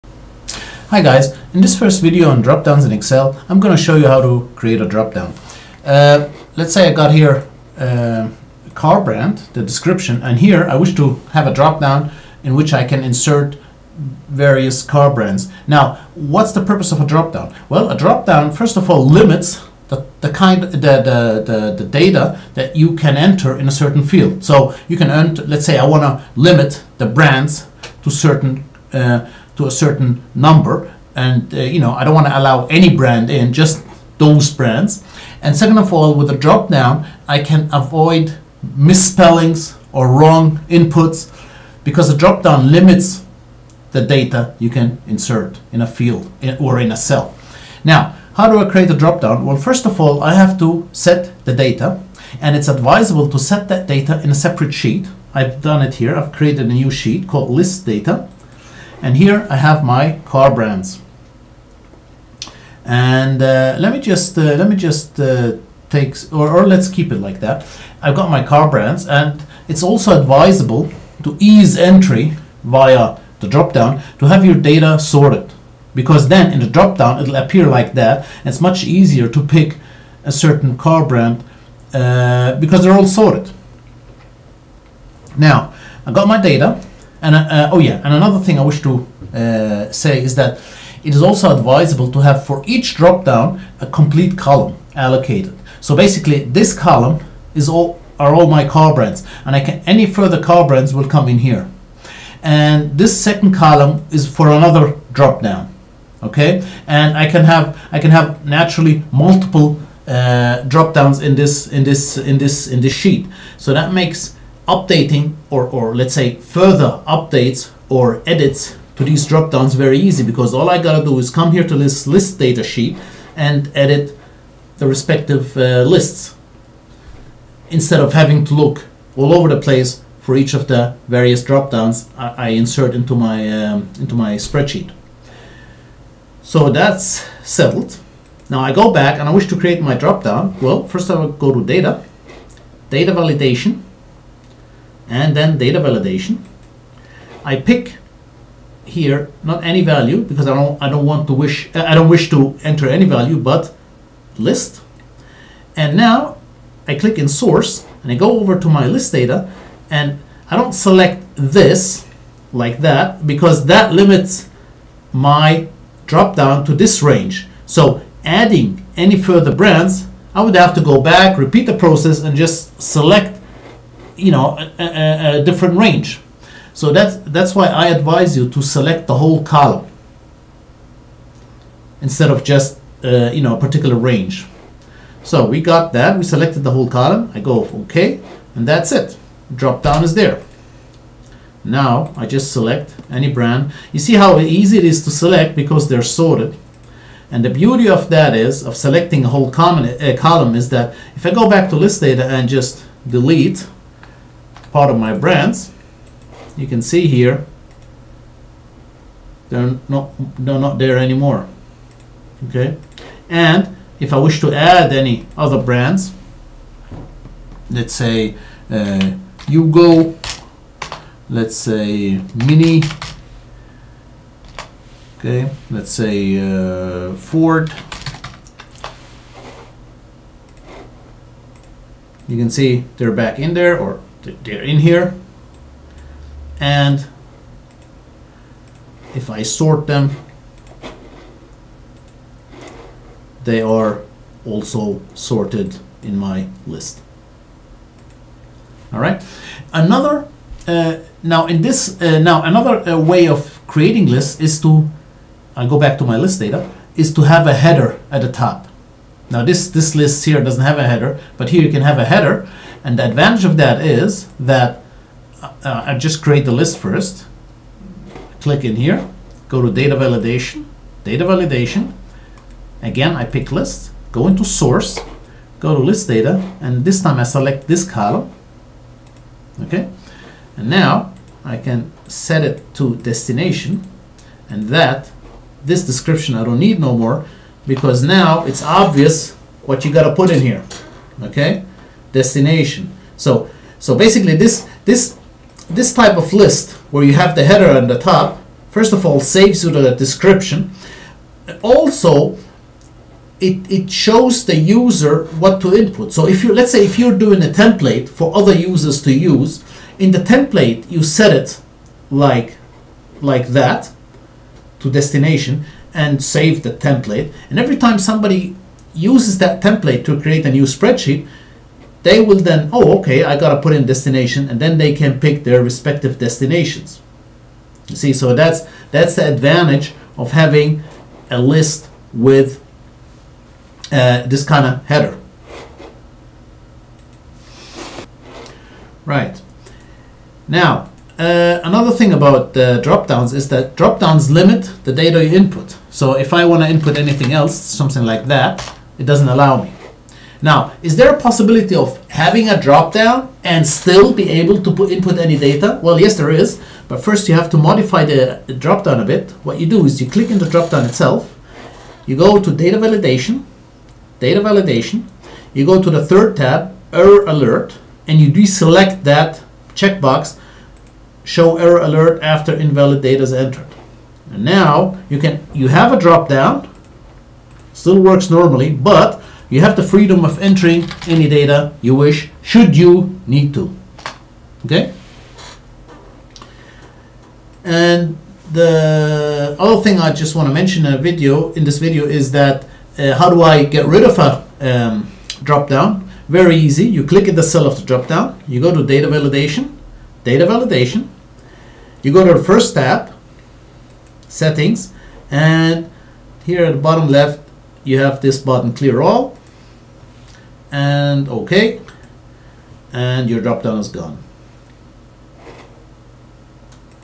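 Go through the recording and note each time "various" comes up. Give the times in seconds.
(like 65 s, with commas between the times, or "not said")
14 s, 131 s.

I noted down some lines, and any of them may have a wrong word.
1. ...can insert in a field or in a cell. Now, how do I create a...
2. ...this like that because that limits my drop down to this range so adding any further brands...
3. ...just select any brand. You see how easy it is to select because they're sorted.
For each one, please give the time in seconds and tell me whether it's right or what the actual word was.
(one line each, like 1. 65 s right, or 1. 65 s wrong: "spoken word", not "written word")
1. 44 s right
2. 161 s right
3. 192 s right.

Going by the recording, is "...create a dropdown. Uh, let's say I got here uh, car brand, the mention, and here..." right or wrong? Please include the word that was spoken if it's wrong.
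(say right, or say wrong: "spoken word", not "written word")
wrong: "description", not "mention".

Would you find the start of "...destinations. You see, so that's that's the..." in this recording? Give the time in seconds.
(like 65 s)
326 s.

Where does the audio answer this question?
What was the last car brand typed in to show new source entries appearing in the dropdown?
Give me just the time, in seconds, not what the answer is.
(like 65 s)
227 s.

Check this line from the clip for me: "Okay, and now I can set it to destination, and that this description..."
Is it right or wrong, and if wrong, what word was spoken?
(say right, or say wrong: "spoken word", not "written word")
right.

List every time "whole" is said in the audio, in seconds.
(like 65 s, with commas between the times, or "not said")
179 s, 186 s, 199 s.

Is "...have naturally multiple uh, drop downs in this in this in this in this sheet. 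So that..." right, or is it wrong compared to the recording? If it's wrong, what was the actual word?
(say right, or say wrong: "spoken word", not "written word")
right.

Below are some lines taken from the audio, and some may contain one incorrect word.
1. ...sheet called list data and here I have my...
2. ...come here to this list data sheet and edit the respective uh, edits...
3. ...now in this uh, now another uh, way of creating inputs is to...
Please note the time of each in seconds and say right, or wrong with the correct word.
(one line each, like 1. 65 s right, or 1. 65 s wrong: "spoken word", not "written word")
1. 56 s right
2. 121 s wrong: "lists", not "edits"
3. 251 s wrong: "lists", not "inputs".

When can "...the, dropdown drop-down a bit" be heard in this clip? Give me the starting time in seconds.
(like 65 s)
358 s.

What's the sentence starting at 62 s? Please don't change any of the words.
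And uh, let me just uh, let me just uh, take or, or let's keep it like that.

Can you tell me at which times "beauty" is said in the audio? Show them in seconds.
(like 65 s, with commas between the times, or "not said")
197 s.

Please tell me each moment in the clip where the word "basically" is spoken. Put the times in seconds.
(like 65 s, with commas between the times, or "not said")
95 s, 293 s.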